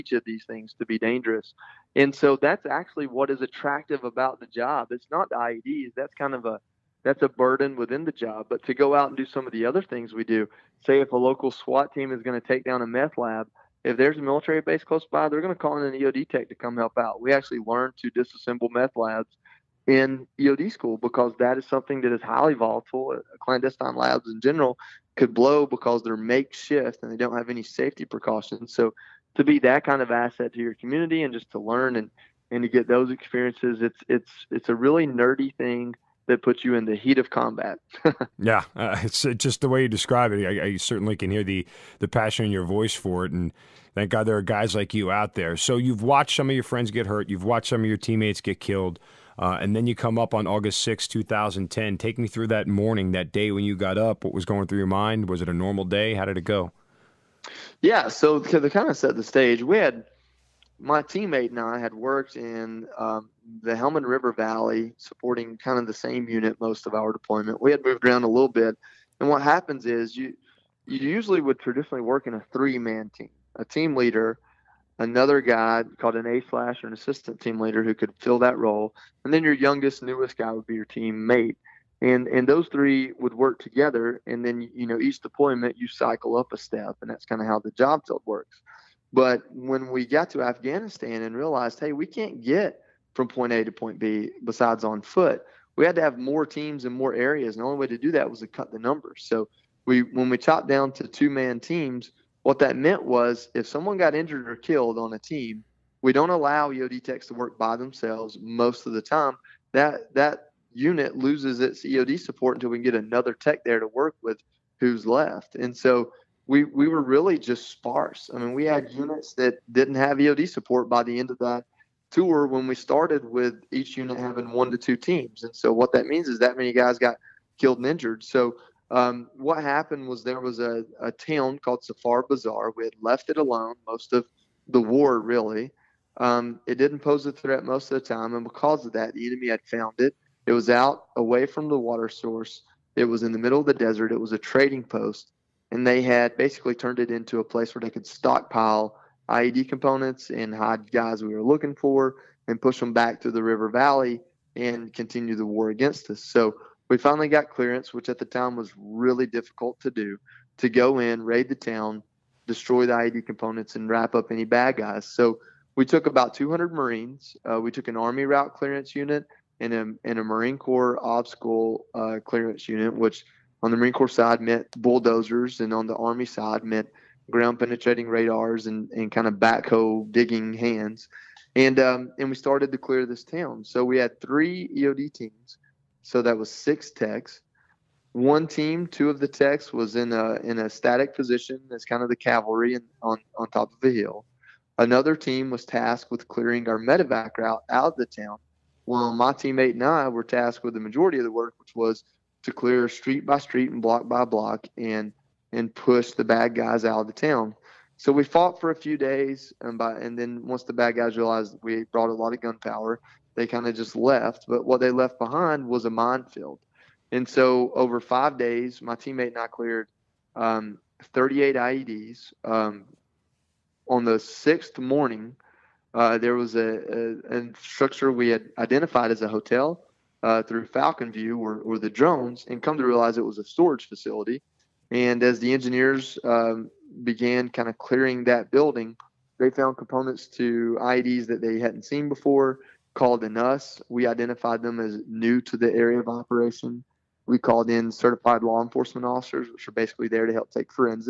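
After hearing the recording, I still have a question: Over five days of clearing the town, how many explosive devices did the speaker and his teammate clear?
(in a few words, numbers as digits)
38.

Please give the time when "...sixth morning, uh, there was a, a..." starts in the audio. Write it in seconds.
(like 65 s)
224 s.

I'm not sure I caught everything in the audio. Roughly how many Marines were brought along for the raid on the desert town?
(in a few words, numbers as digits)
200.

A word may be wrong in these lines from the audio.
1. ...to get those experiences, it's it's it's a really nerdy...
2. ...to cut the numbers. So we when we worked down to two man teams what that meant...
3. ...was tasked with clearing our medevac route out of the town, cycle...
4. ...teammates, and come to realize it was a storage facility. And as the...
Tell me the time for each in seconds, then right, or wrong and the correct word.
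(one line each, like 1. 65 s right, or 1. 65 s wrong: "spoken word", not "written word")
1. 32 s right
2. 98 s wrong: "chopped", not "worked"
3. 195 s wrong: "while", not "cycle"
4. 231 s wrong: "drones", not "teammates".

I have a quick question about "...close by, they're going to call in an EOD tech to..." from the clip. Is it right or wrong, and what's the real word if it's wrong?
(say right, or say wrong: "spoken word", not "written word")
right.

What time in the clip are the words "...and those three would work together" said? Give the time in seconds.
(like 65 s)
82 s.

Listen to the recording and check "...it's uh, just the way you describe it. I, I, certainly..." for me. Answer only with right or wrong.
right.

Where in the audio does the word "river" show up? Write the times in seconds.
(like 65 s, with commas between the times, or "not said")
64 s, 153 s.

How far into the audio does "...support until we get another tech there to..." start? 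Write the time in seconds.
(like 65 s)
112 s.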